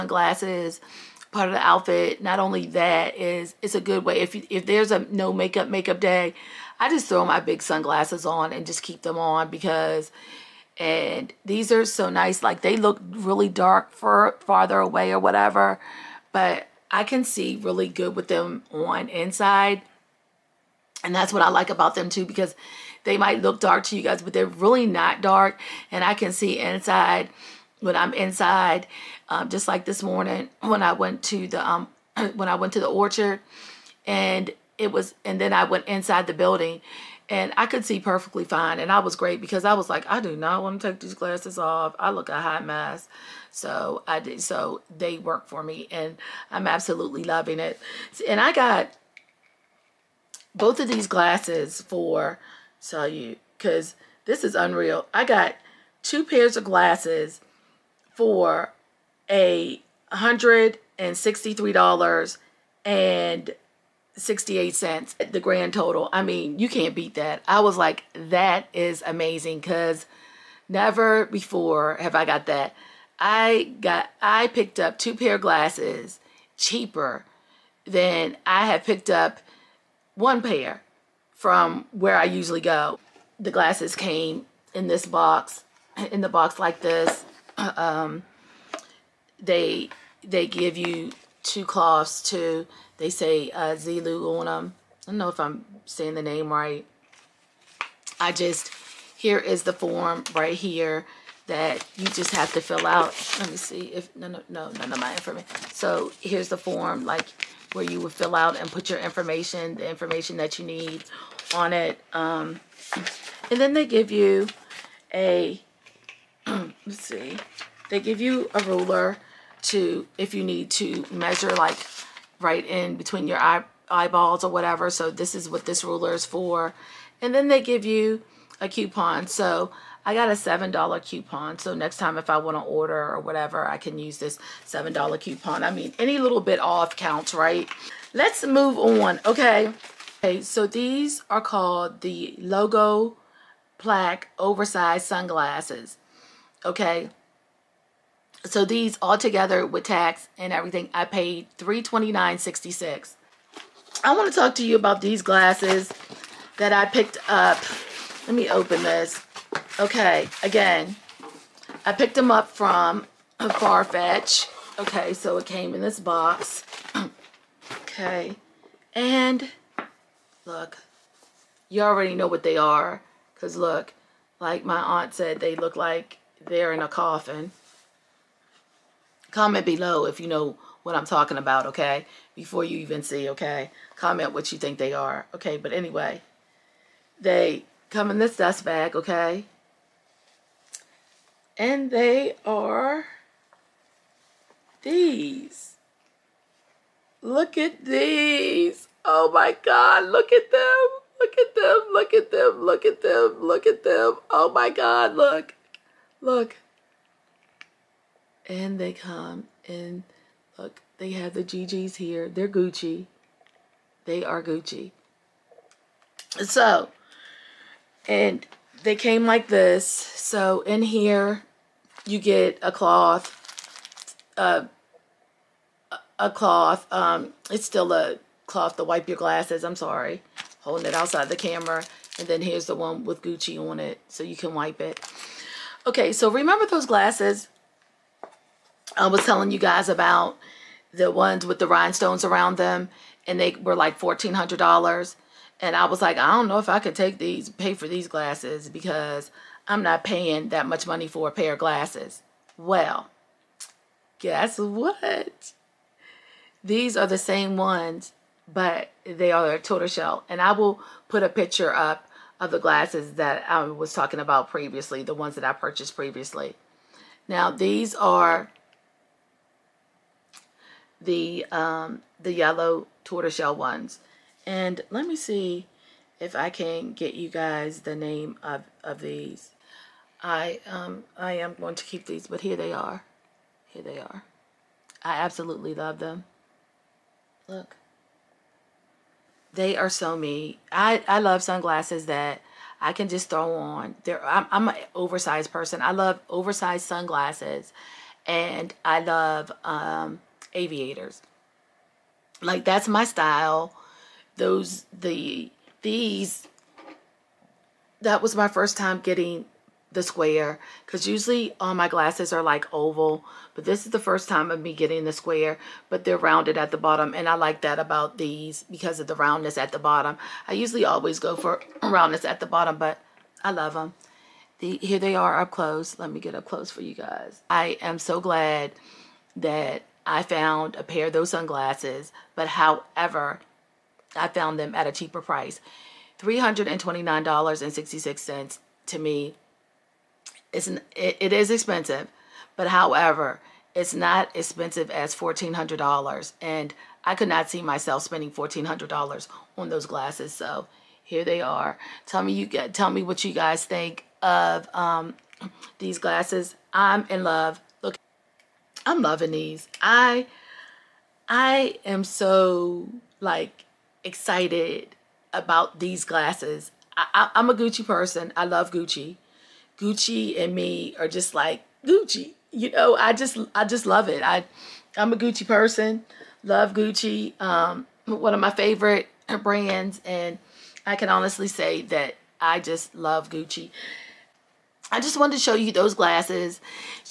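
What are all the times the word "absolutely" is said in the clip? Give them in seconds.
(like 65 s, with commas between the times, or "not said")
46 s, 285 s.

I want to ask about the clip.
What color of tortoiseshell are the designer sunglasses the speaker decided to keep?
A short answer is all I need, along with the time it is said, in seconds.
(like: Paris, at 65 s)
Yellow, at 272 s.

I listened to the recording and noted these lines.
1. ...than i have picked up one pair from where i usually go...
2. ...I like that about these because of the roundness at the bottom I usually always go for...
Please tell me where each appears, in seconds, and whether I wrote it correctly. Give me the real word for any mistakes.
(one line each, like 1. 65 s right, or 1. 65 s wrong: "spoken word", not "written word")
1. 77 s right
2. 317 s right.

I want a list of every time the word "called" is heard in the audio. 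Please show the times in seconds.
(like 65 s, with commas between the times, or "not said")
141 s.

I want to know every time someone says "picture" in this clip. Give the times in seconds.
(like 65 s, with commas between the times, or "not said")
261 s.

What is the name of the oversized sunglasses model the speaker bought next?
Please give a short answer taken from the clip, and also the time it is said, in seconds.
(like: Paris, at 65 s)
Logo Plaque Oversized Sunglasses, at 142 s.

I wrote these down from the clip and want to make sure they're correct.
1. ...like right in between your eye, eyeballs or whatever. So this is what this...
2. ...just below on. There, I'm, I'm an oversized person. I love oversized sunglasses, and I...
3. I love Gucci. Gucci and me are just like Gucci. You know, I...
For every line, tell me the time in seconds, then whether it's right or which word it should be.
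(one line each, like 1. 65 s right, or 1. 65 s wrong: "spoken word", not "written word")
1. 121 s right
2. 293 s wrong: "throw", not "below"
3. 368 s right.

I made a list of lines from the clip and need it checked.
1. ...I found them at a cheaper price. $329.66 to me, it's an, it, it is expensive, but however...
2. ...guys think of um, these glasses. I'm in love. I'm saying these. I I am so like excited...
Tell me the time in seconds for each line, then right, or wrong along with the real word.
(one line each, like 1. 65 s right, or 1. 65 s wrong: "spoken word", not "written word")
1. 334 s right
2. 353 s wrong: "loving", not "saying".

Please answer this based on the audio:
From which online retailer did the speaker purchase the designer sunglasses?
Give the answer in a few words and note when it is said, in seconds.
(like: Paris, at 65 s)
Farfetch, at 163 s.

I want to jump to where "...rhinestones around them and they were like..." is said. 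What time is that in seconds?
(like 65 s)
241 s.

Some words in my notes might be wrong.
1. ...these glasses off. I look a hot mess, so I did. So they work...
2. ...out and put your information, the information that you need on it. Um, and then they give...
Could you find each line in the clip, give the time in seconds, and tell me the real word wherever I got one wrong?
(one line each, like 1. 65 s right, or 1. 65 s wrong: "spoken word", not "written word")
1. 41 s right
2. 108 s right.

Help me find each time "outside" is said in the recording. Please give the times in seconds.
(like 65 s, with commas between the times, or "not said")
230 s.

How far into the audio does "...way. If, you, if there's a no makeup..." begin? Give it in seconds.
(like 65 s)
4 s.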